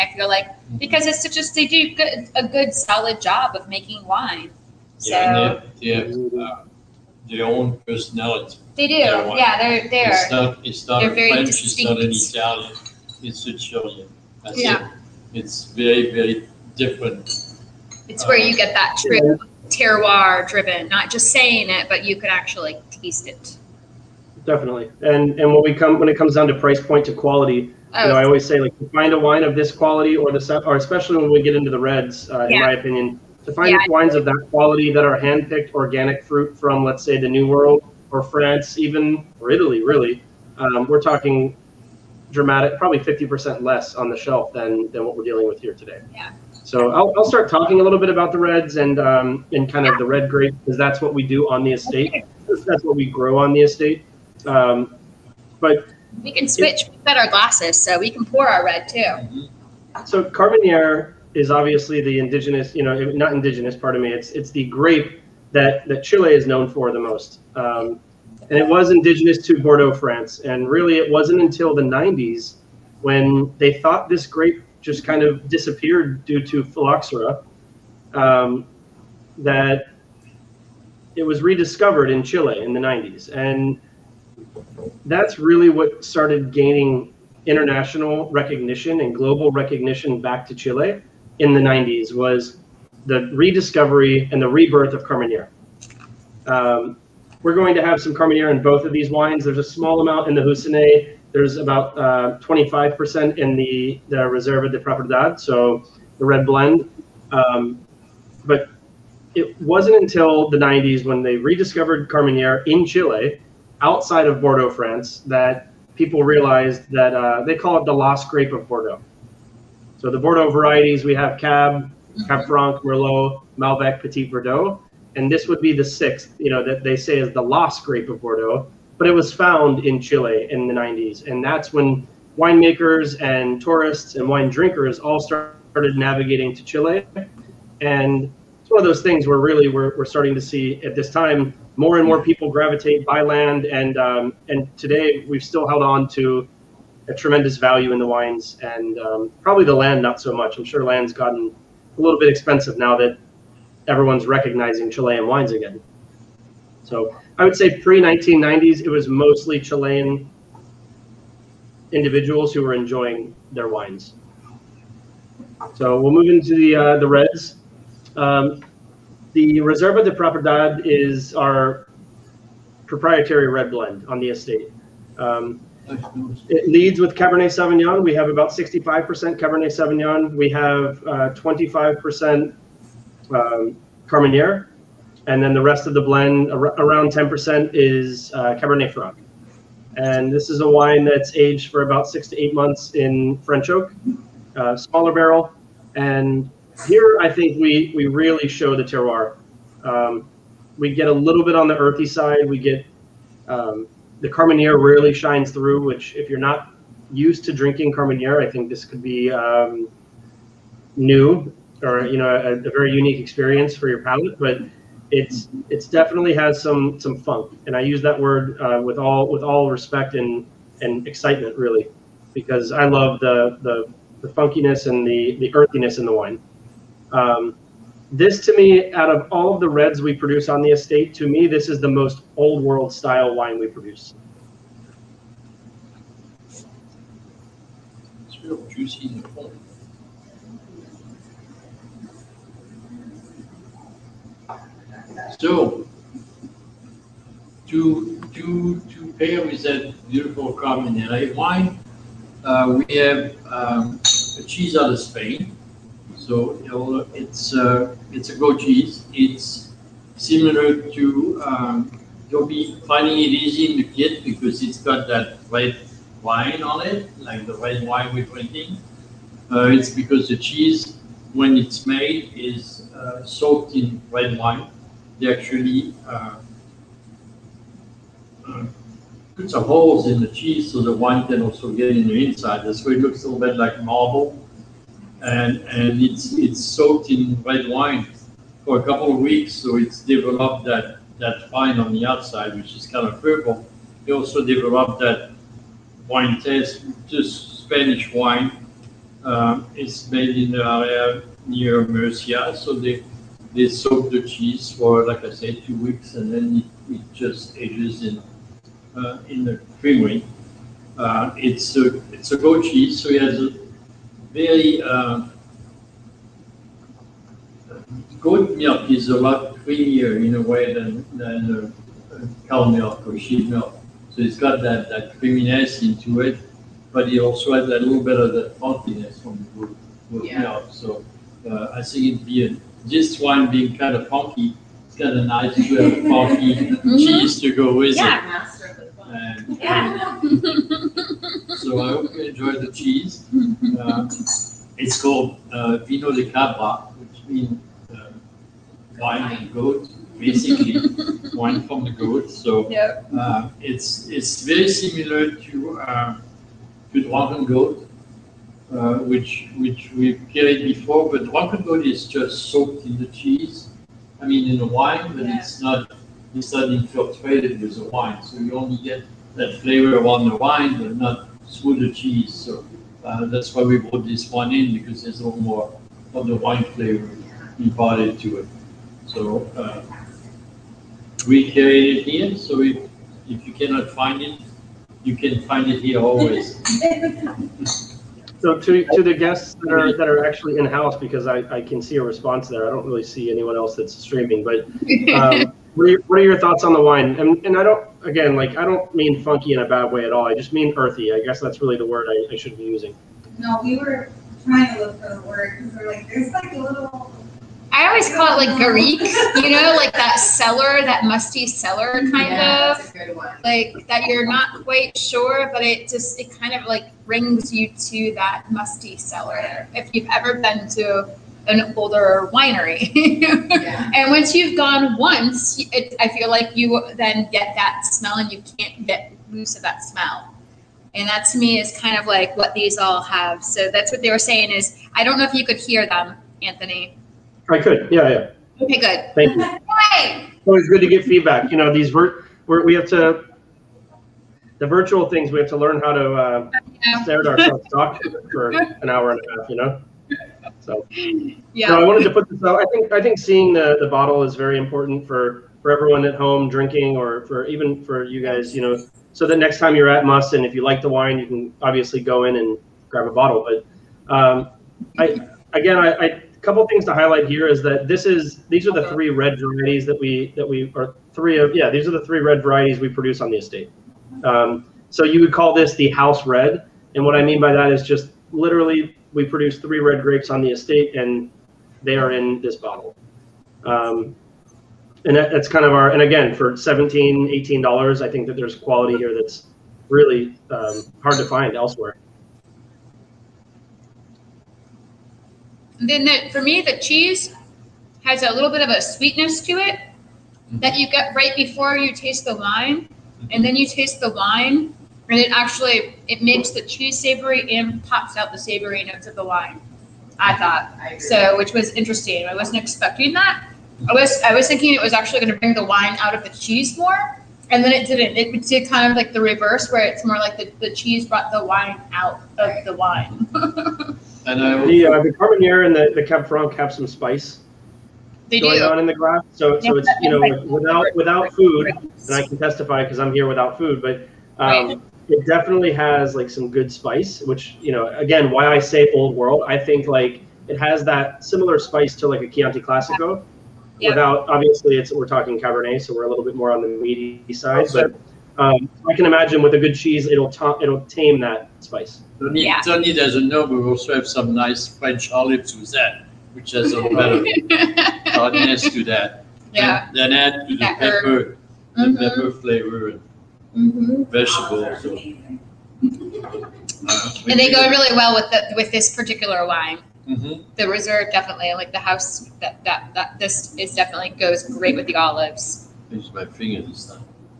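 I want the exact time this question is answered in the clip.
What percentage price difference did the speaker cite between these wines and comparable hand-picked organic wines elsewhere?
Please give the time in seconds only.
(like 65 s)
42 s.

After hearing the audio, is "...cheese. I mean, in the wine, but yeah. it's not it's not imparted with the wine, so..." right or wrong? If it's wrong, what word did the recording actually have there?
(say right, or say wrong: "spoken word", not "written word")
wrong: "infiltrated", not "imparted".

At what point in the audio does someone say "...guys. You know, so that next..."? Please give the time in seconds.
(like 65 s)
458 s.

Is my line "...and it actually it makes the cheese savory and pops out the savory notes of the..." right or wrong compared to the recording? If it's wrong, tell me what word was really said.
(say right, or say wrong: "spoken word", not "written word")
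right.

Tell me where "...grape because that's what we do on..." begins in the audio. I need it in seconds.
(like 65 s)
50 s.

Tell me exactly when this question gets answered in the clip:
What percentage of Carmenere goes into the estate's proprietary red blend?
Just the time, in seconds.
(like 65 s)
101 s.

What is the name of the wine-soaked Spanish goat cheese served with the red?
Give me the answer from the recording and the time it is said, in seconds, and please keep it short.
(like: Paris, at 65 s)
Vino de Cabra, at 345 s.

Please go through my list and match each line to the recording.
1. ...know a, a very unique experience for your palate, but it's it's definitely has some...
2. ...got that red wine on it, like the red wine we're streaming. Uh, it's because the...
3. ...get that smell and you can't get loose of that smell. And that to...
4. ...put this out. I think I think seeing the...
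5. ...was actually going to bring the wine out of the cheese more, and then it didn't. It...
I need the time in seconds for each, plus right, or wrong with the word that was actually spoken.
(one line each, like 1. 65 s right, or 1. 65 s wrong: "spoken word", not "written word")
1. 212 s right
2. 264 s wrong: "drinking", not "streaming"
3. 427 s right
4. 452 s right
5. 514 s right.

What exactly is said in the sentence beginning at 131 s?
And that's when winemakers and tourists and wine drinkers all started navigating to Chile.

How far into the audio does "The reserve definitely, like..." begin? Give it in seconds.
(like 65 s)
570 s.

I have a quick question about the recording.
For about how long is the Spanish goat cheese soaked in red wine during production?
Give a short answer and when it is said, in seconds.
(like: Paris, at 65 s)
2 weeks, at 305 s.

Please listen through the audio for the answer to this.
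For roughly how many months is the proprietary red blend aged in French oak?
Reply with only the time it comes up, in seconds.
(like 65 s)
192 s.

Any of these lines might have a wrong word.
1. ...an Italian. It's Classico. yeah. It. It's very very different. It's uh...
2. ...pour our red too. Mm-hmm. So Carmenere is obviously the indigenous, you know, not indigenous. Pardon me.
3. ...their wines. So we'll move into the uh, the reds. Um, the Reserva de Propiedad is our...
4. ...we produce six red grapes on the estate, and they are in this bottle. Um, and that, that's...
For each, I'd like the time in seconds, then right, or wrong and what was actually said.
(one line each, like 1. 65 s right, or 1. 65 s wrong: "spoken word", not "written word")
1. 12 s wrong: "Sicilian", not "Classico"
2. 58 s right
3. 163 s right
4. 479 s wrong: "three", not "six".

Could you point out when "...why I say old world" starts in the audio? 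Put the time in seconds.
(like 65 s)
538 s.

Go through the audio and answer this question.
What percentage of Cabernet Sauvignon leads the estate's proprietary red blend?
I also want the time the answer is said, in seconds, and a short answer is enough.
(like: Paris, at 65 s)
65%, at 178 s.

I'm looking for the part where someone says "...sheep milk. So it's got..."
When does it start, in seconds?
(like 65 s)
323 s.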